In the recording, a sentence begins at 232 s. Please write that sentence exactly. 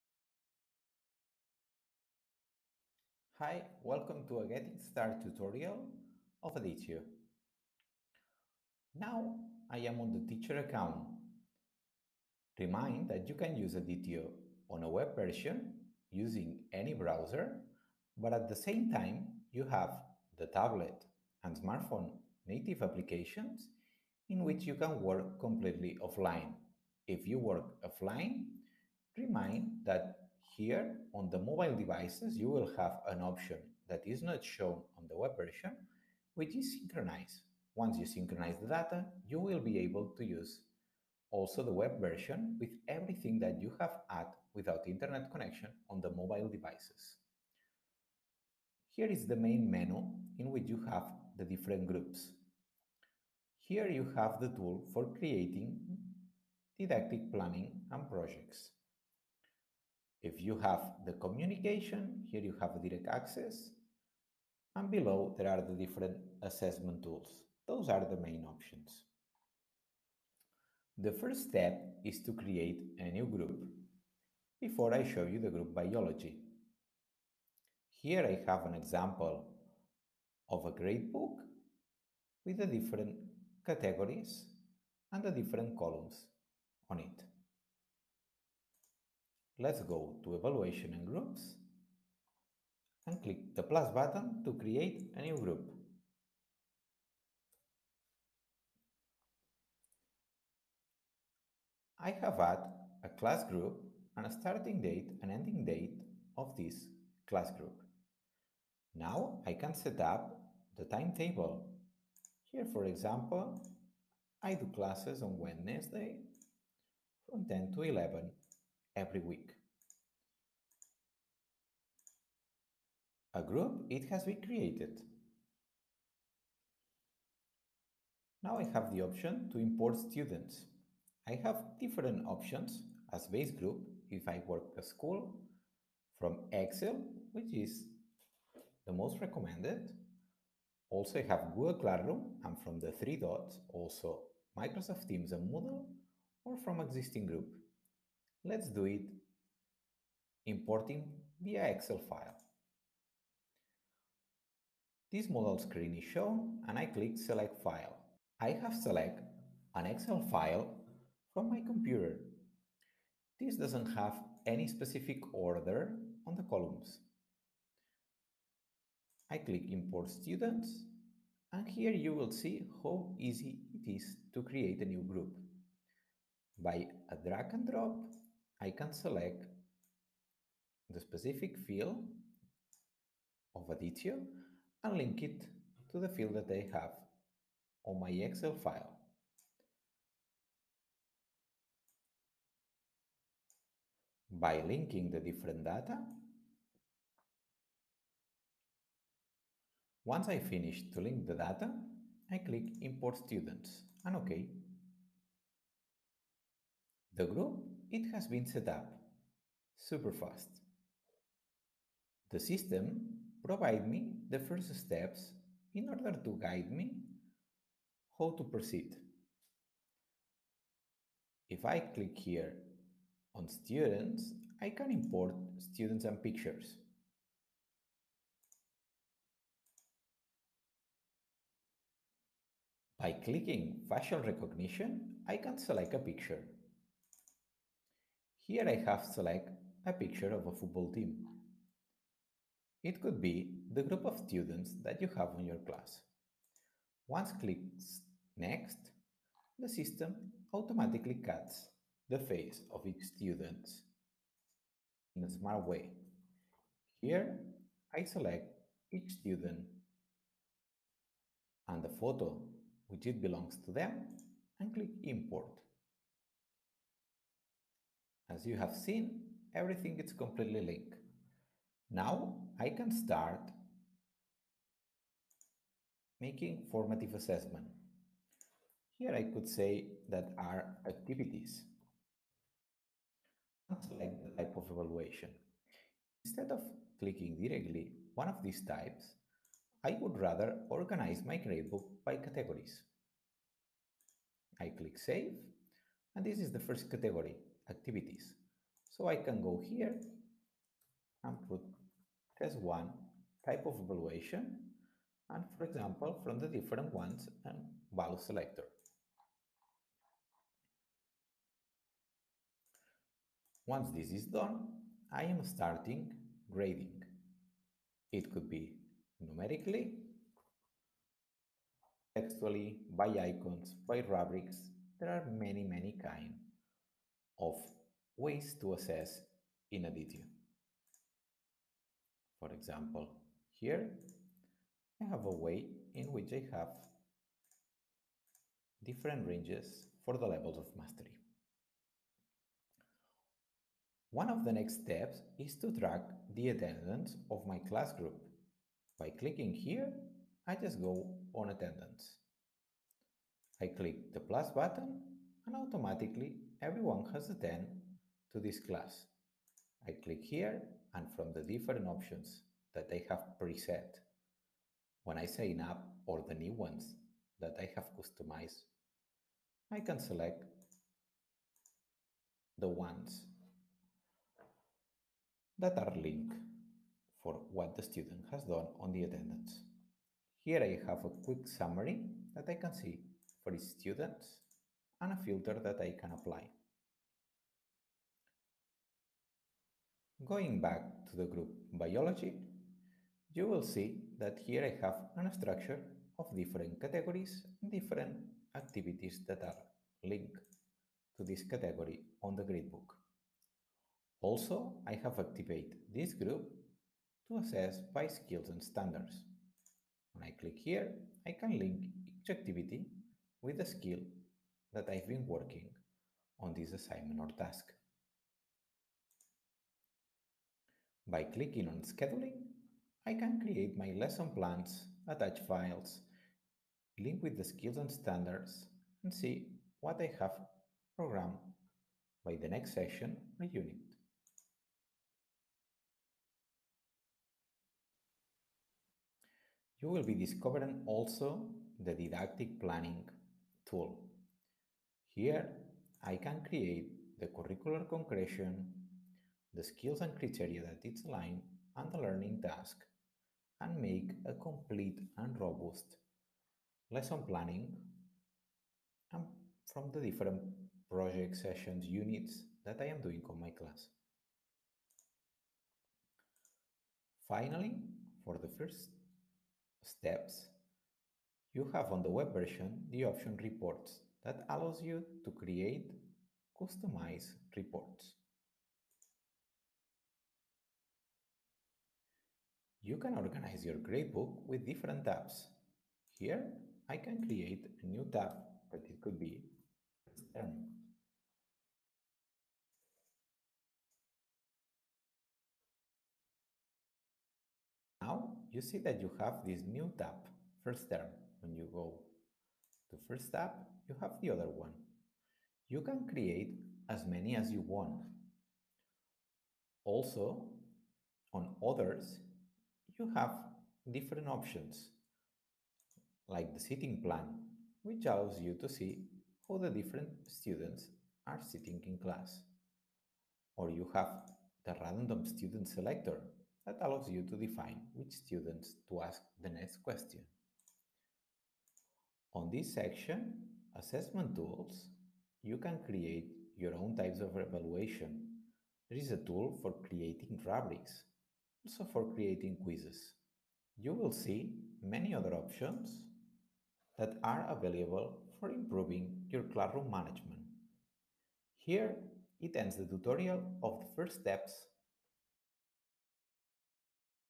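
By clicking facial recognition, I can select a picture.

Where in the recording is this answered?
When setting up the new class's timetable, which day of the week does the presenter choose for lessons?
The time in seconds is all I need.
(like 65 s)
115 s.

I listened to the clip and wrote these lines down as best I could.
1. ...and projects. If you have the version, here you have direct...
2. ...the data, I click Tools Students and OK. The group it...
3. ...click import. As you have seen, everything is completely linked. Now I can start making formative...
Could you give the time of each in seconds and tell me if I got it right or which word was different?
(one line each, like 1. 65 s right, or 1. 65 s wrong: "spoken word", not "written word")
1. 57 s wrong: "communication", not "version"
2. 201 s wrong: "Import", not "Tools"
3. 264 s right.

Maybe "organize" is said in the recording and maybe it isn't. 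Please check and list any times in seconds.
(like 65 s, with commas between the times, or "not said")
290 s, 483 s.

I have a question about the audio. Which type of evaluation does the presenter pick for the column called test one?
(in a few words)
Value selector.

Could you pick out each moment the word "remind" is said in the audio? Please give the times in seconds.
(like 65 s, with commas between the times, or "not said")
12 s, 29 s.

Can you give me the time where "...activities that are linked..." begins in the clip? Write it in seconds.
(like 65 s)
398 s.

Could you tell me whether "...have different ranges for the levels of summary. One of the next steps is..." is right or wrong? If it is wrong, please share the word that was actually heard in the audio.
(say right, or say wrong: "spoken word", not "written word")
wrong: "mastery", not "summary".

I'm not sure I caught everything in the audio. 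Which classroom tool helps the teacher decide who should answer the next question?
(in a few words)
Random student selector.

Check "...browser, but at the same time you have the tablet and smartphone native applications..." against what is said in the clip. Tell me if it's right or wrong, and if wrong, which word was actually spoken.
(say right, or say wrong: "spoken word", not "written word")
right.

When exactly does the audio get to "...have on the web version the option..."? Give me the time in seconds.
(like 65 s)
471 s.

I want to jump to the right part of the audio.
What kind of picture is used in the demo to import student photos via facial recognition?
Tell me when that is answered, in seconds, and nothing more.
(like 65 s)
240 s.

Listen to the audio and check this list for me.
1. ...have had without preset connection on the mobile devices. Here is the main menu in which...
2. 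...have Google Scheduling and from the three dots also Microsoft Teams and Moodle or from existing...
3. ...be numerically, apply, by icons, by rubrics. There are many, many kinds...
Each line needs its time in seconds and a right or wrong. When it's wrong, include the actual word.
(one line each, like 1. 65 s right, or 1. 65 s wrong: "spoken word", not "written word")
1. 43 s wrong: "internet", not "preset"
2. 141 s wrong: "Classroom", not "Scheduling"
3. 318 s wrong: "textually", not "apply".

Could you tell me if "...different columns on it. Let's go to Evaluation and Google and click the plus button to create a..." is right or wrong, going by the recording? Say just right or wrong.
wrong.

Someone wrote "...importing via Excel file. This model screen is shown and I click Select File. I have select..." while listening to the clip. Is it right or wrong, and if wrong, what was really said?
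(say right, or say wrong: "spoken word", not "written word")
right.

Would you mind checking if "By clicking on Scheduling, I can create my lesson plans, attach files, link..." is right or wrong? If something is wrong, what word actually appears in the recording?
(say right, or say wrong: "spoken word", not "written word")
right.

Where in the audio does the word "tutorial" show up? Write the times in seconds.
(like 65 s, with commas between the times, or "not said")
5 s, 552 s.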